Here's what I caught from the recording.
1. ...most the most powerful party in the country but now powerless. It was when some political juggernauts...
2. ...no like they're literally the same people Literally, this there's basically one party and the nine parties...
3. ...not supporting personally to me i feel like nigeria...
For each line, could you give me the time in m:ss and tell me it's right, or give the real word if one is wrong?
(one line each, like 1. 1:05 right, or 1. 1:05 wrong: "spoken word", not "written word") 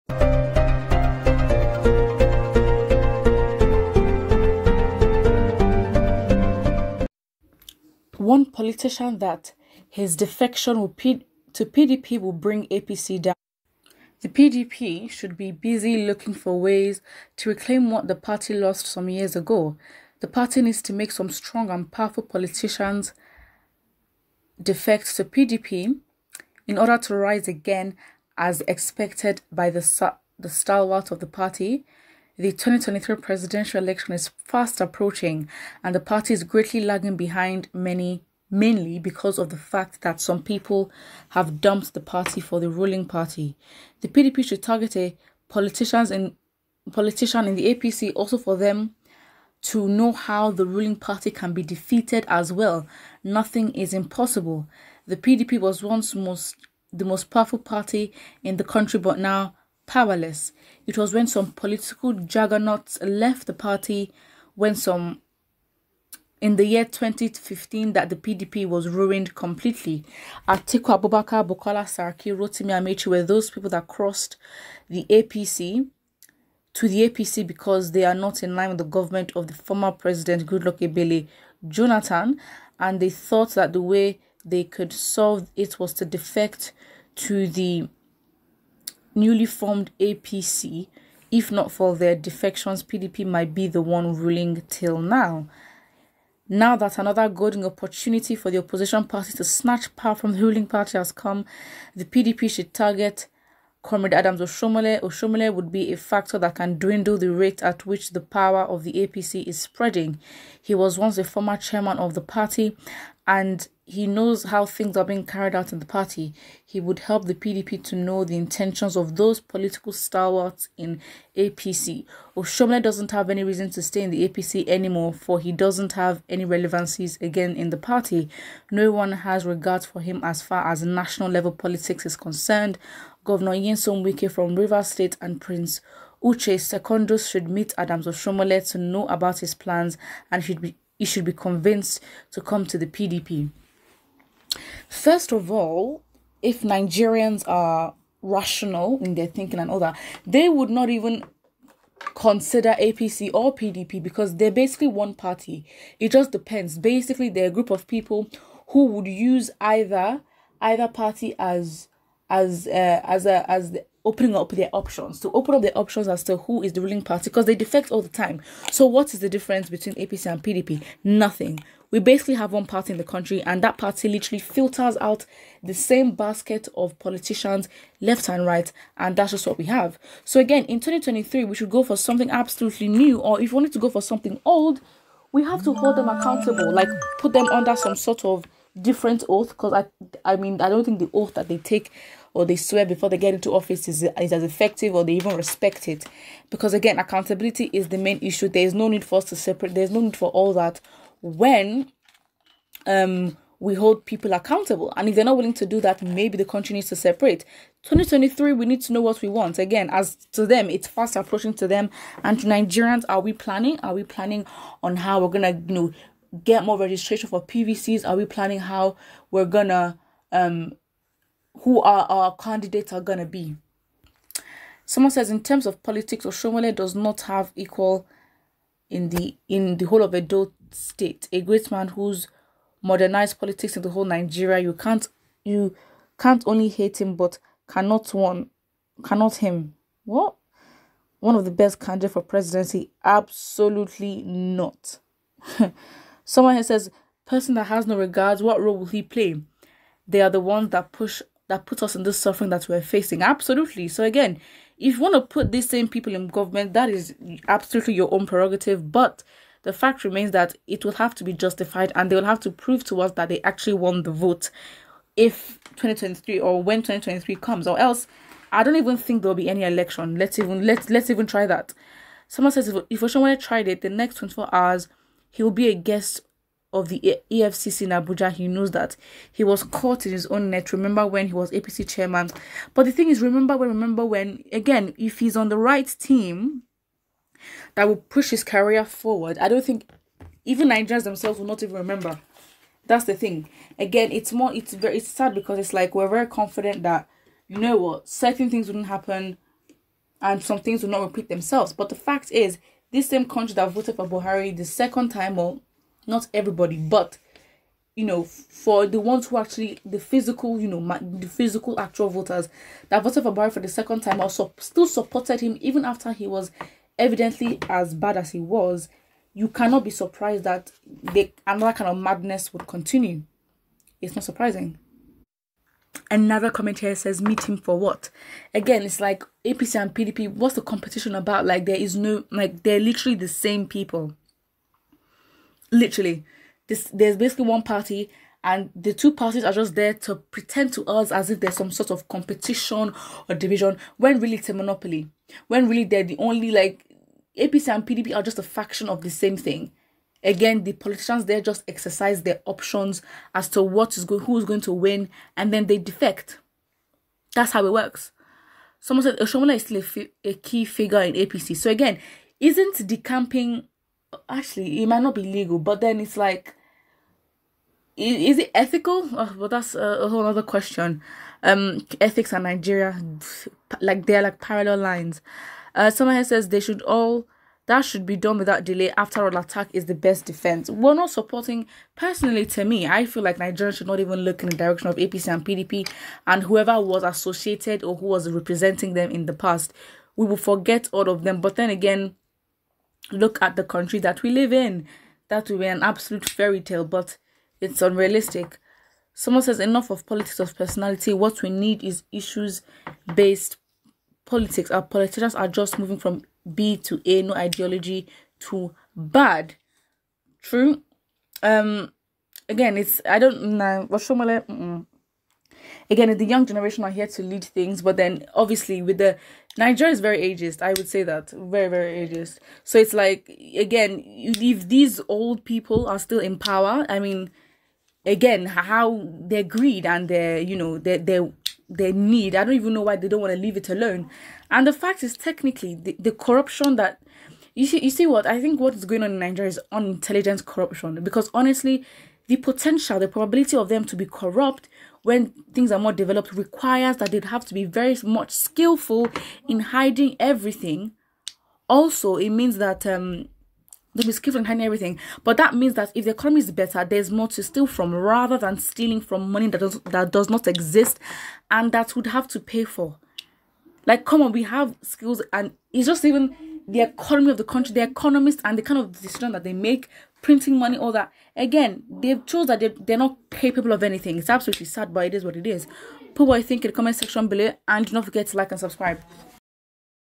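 1. 0:56 right
2. 5:31 wrong: "two", not "nine"
3. 6:20 right.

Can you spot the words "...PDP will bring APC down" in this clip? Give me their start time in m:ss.
0:11.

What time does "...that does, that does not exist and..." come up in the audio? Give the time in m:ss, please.
7:39.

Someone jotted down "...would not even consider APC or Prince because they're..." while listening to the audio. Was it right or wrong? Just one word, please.
wrong.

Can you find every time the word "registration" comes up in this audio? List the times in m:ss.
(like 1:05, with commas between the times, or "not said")
3:36.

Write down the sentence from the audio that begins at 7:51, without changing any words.
Again, they've chose that they, are not capable of anything.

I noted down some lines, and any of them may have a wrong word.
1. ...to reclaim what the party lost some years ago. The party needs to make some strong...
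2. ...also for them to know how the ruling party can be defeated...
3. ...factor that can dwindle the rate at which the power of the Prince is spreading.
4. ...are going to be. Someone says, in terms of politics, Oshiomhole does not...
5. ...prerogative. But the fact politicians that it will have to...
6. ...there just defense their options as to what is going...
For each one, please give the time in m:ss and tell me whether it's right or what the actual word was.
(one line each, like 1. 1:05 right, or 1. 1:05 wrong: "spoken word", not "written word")
1. 0:17 right
2. 0:48 right
3. 1:45 wrong: "APC", not "Prince"
4. 3:42 right
5. 4:18 wrong: "remains", not "politicians"
6. 5:51 wrong: "exercise", not "defense".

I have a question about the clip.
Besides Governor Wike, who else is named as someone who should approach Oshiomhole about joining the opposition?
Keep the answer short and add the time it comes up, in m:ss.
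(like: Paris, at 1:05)
Uche Secondus, at 2:16.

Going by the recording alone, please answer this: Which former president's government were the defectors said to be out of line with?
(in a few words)
Goodluck Ebele Jonathan.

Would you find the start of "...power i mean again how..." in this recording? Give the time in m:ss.
7:06.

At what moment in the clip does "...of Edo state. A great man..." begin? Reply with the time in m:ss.
3:50.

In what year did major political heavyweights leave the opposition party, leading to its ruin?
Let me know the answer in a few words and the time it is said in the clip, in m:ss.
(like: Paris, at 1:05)
2015, at 1:06.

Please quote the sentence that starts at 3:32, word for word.
And to Nigerians, are we planning?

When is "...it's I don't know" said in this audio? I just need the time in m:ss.
6:52.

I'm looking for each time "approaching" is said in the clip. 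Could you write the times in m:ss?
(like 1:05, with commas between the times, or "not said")
0:34, 3:31.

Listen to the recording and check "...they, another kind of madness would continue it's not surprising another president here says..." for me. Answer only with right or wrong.
wrong.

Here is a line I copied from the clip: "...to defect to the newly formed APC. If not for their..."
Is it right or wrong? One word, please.
right.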